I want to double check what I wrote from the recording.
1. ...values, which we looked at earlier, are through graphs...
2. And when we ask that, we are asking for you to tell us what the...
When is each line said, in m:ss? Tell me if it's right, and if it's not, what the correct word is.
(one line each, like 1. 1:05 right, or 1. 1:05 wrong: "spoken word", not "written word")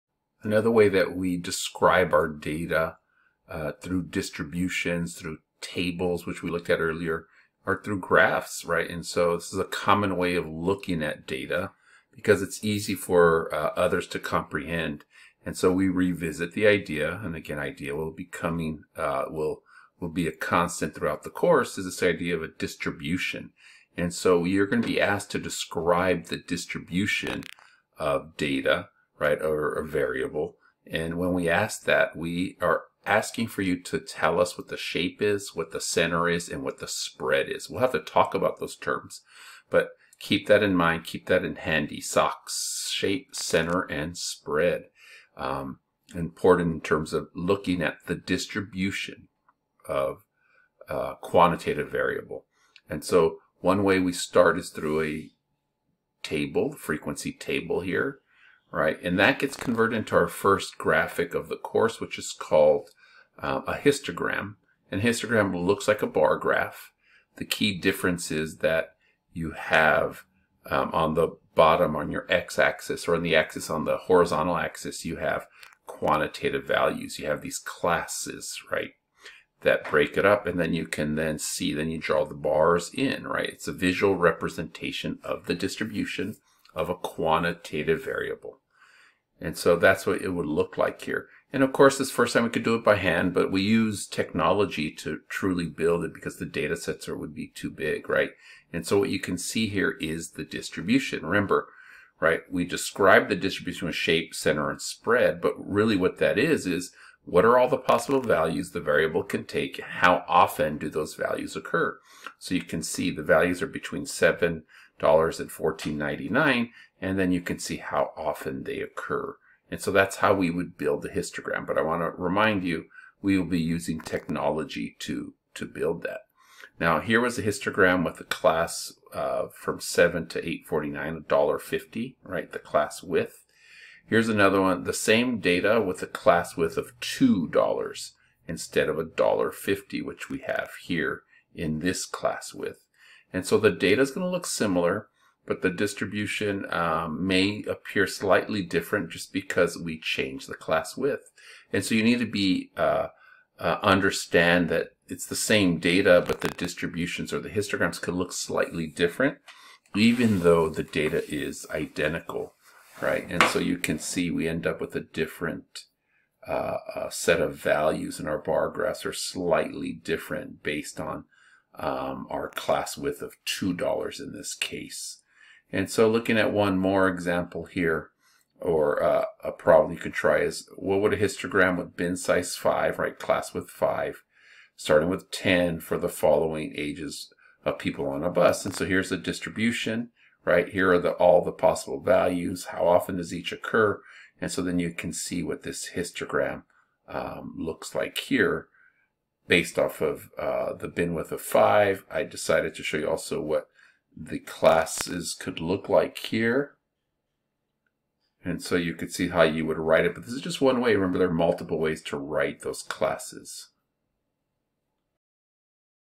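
1. 0:05 wrong: "tables", not "values"
2. 0:30 right.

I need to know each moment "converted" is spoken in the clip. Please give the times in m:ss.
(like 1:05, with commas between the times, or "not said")
0:59.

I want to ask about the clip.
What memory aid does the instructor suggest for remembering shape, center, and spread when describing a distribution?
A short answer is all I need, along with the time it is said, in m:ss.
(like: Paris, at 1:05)
Socks, at 0:42.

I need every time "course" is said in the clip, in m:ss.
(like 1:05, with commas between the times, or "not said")
0:21, 1:01, 1:31.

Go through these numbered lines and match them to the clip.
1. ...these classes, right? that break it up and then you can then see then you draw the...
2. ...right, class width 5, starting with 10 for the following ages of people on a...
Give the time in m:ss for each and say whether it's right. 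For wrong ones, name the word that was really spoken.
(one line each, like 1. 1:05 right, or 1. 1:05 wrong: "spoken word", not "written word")
1. 1:17 right
2. 3:02 right.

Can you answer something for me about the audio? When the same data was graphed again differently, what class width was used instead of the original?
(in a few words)
$2.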